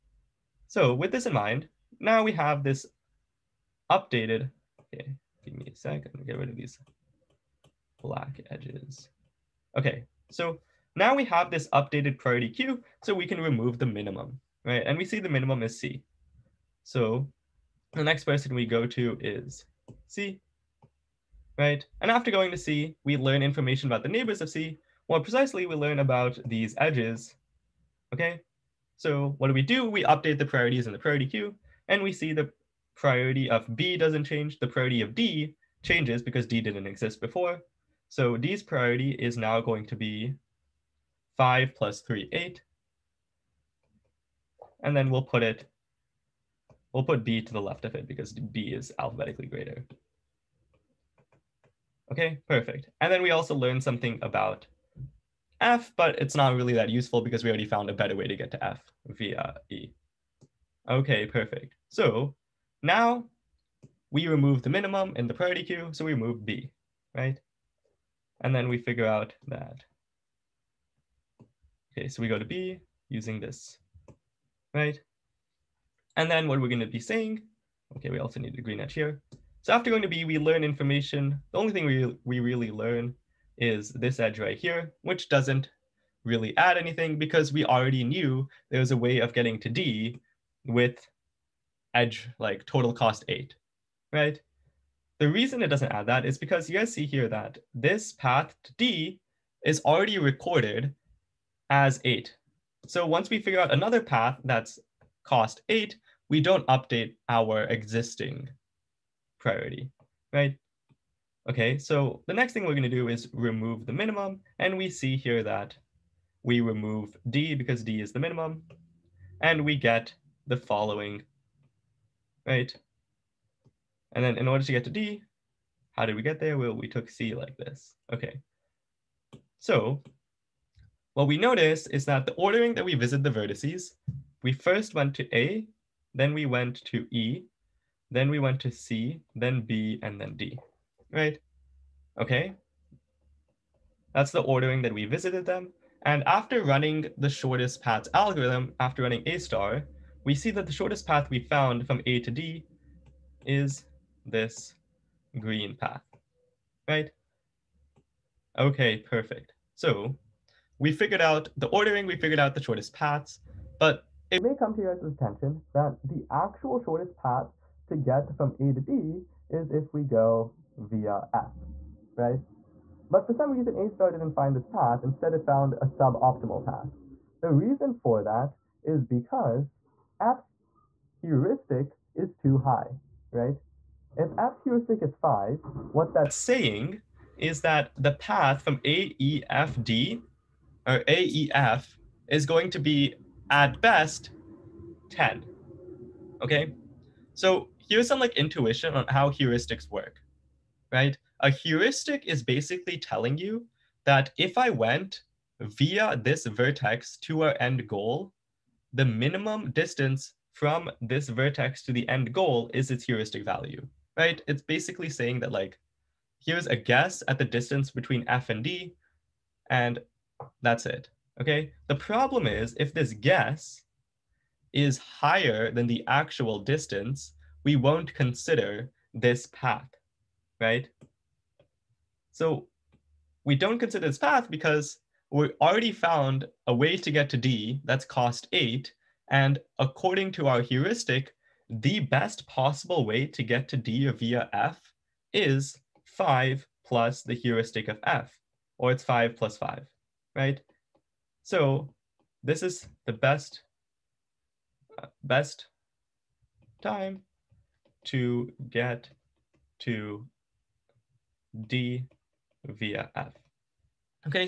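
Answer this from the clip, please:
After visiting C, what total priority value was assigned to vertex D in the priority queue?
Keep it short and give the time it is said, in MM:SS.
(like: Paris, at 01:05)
8, at 00:42.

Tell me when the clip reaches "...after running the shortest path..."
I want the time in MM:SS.
02:26.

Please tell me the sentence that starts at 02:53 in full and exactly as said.
But for some reason, A star didn't find this path.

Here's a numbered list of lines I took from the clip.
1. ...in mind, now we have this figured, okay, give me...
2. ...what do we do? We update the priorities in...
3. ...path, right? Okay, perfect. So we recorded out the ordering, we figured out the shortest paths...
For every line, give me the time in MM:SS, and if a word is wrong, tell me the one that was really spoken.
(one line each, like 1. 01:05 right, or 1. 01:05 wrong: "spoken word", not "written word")
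1. 00:01 wrong: "updated", not "figured"
2. 00:29 right
3. 02:35 wrong: "figured", not "recorded".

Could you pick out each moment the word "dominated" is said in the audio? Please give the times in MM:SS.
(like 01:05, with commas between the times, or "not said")
not said.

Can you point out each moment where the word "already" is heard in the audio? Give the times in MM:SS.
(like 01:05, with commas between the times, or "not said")
00:57, 01:27, 01:39, 03:55.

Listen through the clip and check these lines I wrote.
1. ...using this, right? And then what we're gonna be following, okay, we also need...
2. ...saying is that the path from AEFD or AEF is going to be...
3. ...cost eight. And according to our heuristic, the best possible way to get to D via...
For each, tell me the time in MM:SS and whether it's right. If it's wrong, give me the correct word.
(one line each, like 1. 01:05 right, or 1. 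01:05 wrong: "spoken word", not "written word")
1. 01:13 wrong: "saying", not "following"
2. 03:06 right
3. 03:58 right.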